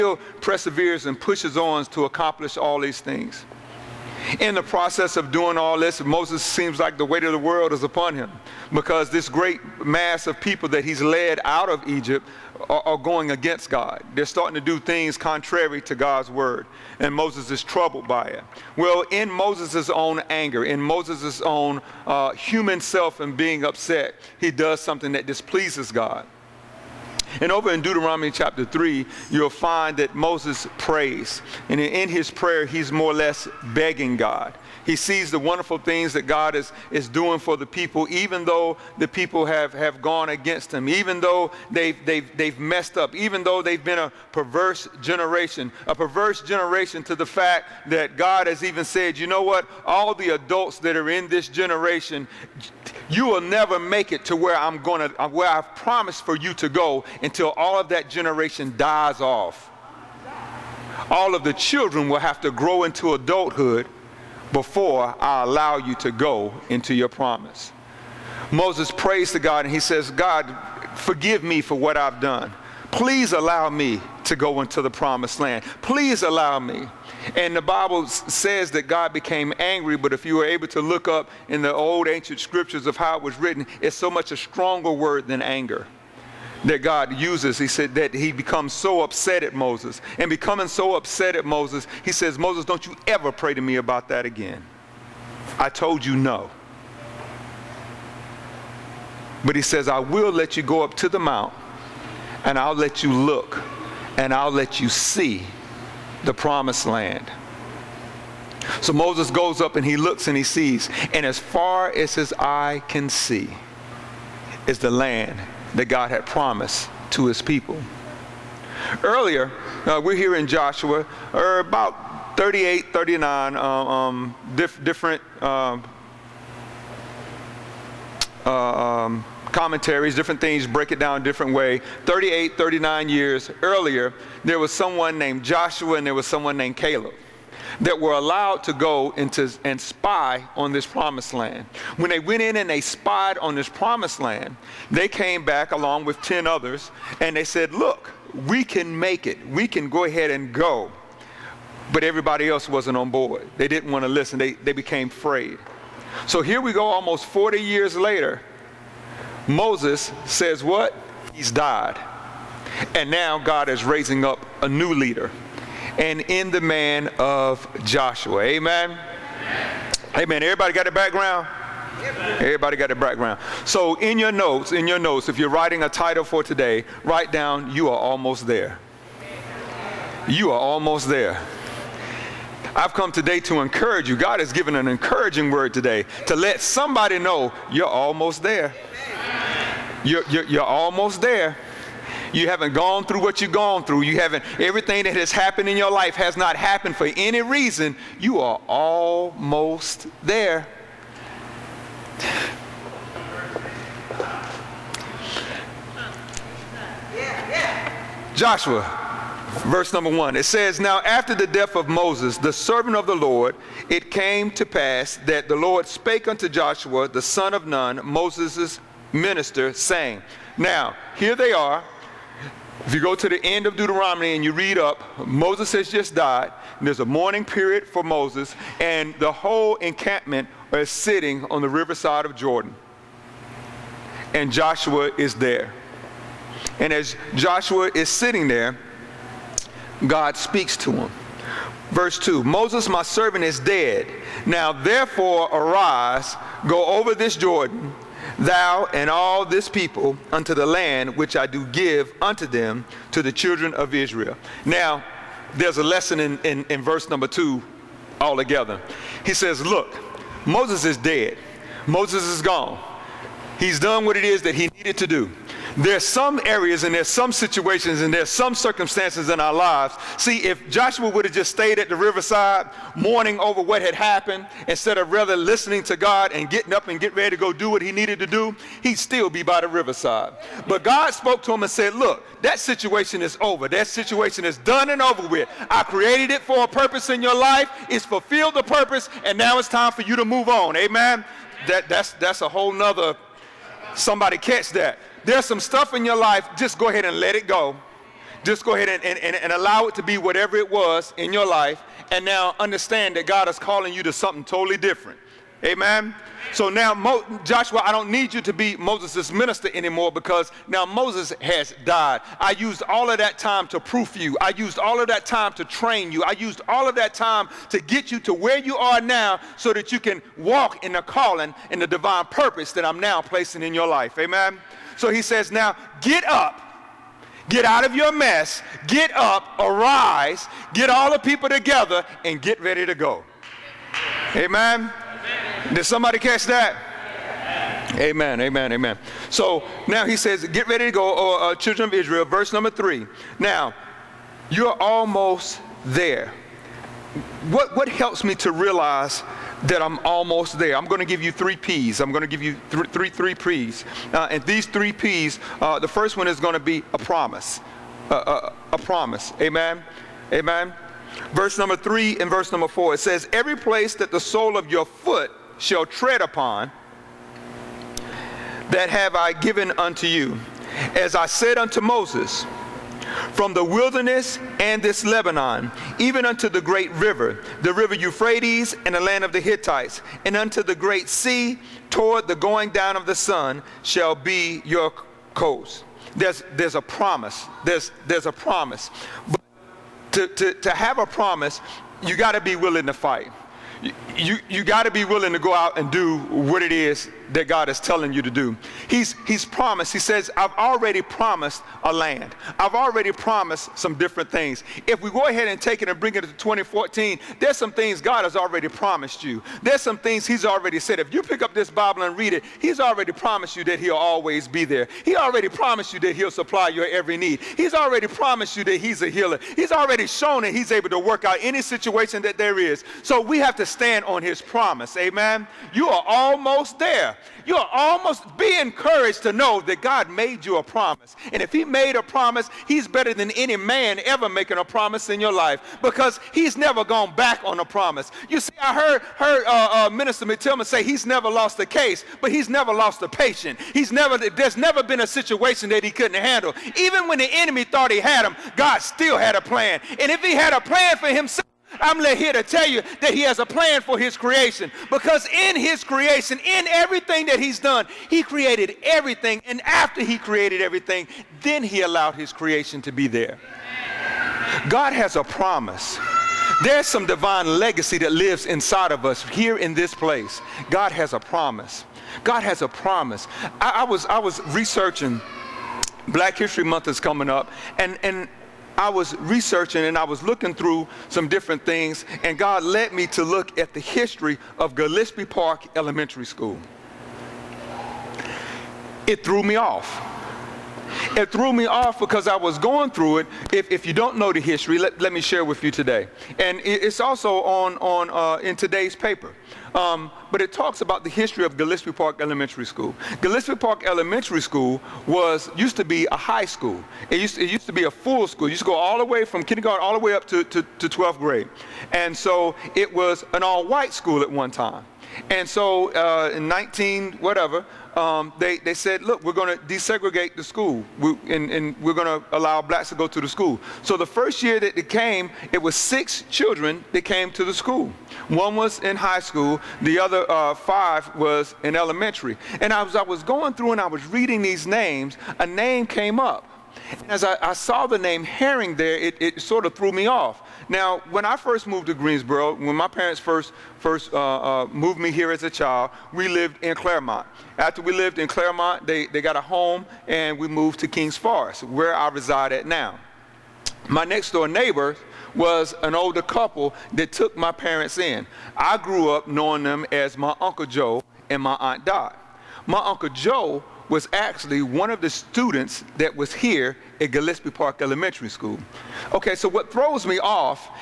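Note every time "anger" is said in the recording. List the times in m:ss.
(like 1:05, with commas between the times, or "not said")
0:20, 1:25.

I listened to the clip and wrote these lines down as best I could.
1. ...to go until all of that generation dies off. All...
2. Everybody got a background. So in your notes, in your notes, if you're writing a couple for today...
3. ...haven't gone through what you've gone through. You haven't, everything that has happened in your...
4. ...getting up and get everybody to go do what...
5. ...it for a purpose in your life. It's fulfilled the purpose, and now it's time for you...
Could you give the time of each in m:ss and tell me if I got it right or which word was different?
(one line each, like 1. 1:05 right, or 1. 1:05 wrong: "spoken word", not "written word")
1. 0:56 right
2. 2:52 wrong: "title", not "couple"
3. 3:12 right
4. 4:36 wrong: "ready", not "everybody"
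5. 4:46 right.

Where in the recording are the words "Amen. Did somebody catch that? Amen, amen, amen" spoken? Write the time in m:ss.
5:34.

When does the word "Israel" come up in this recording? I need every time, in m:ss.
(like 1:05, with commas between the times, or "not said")
4:13, 5:41.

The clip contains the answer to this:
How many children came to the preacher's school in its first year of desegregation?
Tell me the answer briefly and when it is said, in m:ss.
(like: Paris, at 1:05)
6, at 8:45.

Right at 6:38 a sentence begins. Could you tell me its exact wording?
He's, he's promised, he says, I've already promised a land.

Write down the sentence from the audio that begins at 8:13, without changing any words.
If, if you don't know the history, let, let me share with you today.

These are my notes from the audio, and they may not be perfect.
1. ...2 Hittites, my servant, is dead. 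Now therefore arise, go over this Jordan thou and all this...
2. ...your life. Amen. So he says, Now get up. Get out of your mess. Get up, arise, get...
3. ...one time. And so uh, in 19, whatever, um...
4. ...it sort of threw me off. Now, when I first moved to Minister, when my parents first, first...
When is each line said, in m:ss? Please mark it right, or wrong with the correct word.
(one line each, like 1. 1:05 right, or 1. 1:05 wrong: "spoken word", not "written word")
1. 4:02 wrong: "Moses", not "Hittites"
2. 5:23 right
3. 8:34 right
4. 8:59 wrong: "Greensboro", not "Minister".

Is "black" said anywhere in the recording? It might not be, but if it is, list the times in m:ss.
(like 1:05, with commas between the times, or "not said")
7:56, 8:42.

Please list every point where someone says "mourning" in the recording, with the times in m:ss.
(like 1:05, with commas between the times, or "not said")
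3:47, 4:32.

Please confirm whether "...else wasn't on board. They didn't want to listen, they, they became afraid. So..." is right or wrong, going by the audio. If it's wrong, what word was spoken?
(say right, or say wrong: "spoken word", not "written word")
right.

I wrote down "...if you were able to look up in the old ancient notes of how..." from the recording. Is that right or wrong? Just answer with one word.
wrong.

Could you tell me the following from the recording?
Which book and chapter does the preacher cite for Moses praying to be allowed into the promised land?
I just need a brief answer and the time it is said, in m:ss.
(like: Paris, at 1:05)
Deuteronomy chapter 3, at 0:27.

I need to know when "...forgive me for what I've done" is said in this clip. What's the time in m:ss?
1:10.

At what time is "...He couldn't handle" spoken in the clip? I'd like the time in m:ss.
7:25.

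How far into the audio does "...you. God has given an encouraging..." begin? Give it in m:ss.
3:04.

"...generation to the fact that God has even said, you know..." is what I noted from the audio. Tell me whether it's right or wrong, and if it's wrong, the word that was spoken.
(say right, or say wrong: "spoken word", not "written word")
right.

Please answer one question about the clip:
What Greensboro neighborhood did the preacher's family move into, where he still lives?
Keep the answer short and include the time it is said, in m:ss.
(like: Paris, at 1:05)
Kings Forest, at 9:10.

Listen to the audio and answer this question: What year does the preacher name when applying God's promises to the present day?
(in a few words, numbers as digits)
2014.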